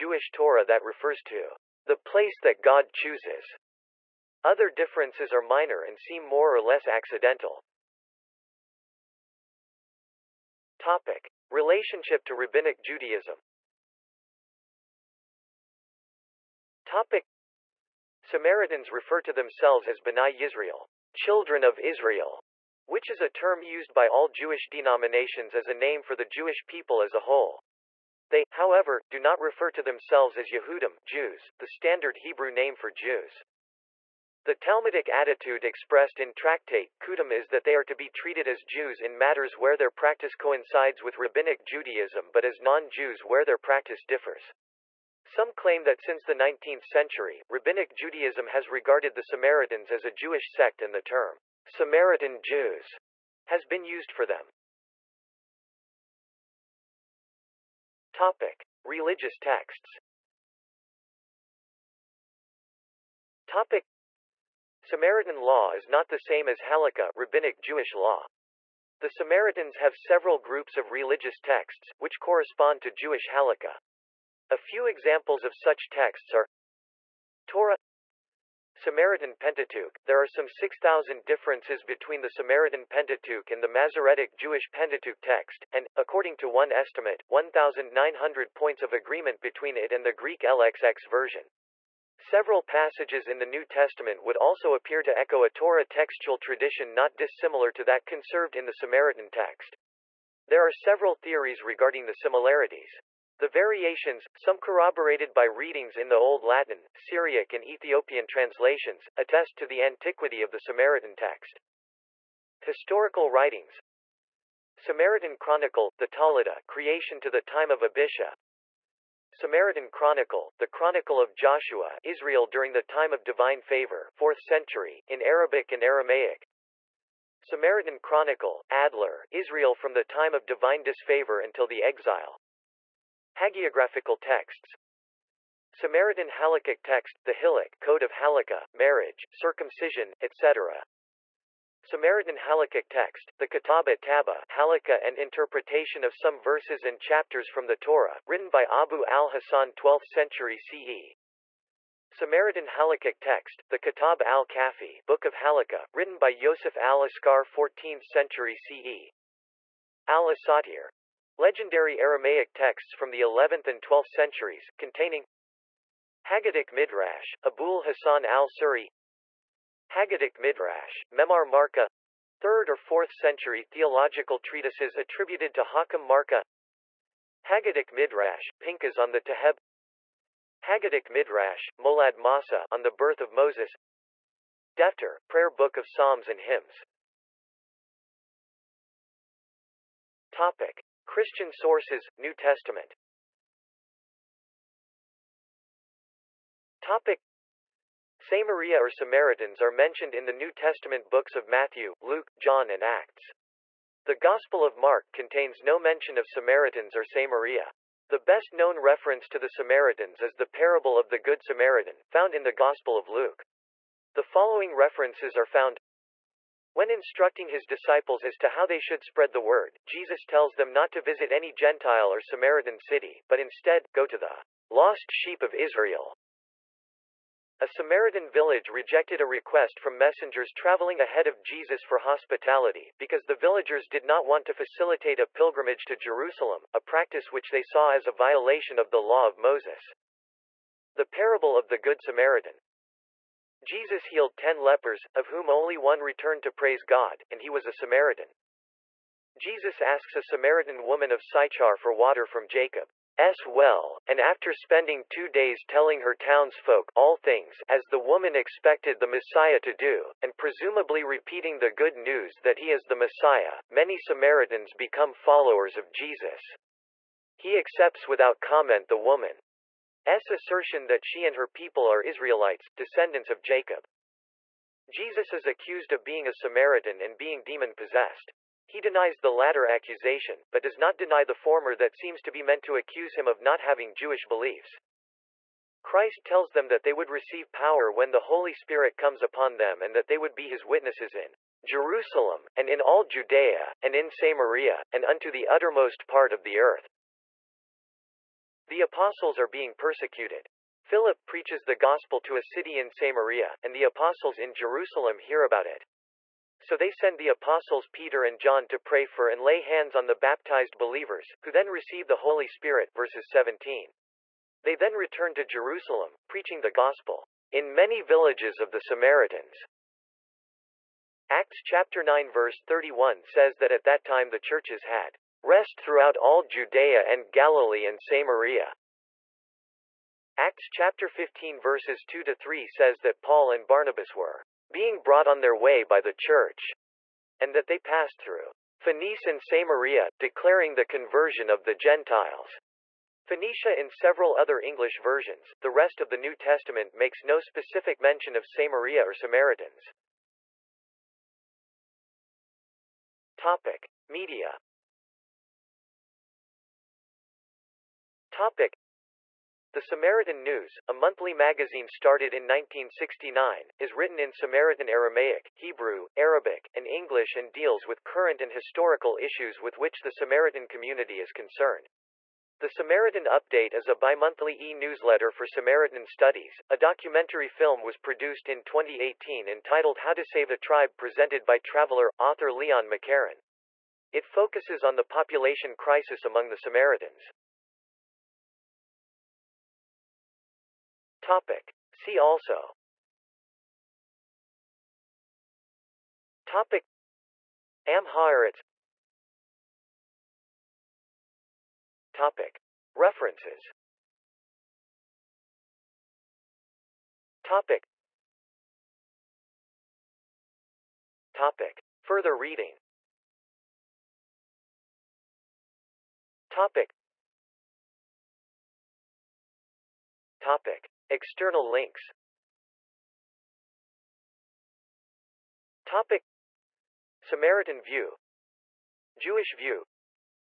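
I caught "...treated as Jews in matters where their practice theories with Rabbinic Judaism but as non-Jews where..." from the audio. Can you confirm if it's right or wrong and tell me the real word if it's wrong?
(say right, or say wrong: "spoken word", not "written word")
wrong: "coincides", not "theories".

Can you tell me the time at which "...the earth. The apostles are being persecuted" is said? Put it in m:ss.
4:56.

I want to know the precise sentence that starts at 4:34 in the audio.
Jesus is accused of being a Samaritan and being demon-possessed.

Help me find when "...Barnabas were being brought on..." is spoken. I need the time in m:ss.
5:33.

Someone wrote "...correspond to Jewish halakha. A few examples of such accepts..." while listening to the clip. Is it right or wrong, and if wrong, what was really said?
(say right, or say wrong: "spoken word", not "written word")
wrong: "texts", not "accepts".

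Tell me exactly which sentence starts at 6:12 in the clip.
The Samaritan Update is a bimonthly e-newsletter for Samaritan Studies.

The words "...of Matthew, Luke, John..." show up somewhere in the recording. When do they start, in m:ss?
3:21.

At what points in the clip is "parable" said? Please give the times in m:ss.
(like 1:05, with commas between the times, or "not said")
3:30, 4:01.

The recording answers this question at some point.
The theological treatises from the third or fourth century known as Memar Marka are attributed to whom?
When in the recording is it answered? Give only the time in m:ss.
2:55.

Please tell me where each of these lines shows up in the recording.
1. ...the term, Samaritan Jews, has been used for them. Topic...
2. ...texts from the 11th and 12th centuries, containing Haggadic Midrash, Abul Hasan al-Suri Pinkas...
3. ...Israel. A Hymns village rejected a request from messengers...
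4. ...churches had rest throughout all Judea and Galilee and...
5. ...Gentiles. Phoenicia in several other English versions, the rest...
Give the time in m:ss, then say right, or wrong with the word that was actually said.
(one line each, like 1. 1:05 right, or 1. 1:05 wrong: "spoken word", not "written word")
1. 0:50 right
2. 2:42 wrong: "Haggadic", not "Pinkas"
3. 3:45 wrong: "Samaritan", not "Hymns"
4. 5:24 right
5. 5:41 right.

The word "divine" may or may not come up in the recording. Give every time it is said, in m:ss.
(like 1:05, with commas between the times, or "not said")
2:03, 2:10.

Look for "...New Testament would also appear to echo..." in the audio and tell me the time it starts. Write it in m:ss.
1:33.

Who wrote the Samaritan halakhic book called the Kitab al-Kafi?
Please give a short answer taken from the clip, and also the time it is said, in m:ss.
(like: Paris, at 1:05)
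Yosef al-Askar, at 2:36.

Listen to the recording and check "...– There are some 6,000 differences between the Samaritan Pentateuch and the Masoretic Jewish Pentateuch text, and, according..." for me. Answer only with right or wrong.
right.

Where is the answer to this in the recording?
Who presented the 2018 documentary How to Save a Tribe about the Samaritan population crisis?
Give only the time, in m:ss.
6:22.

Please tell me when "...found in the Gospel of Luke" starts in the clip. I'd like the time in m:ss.
3:32.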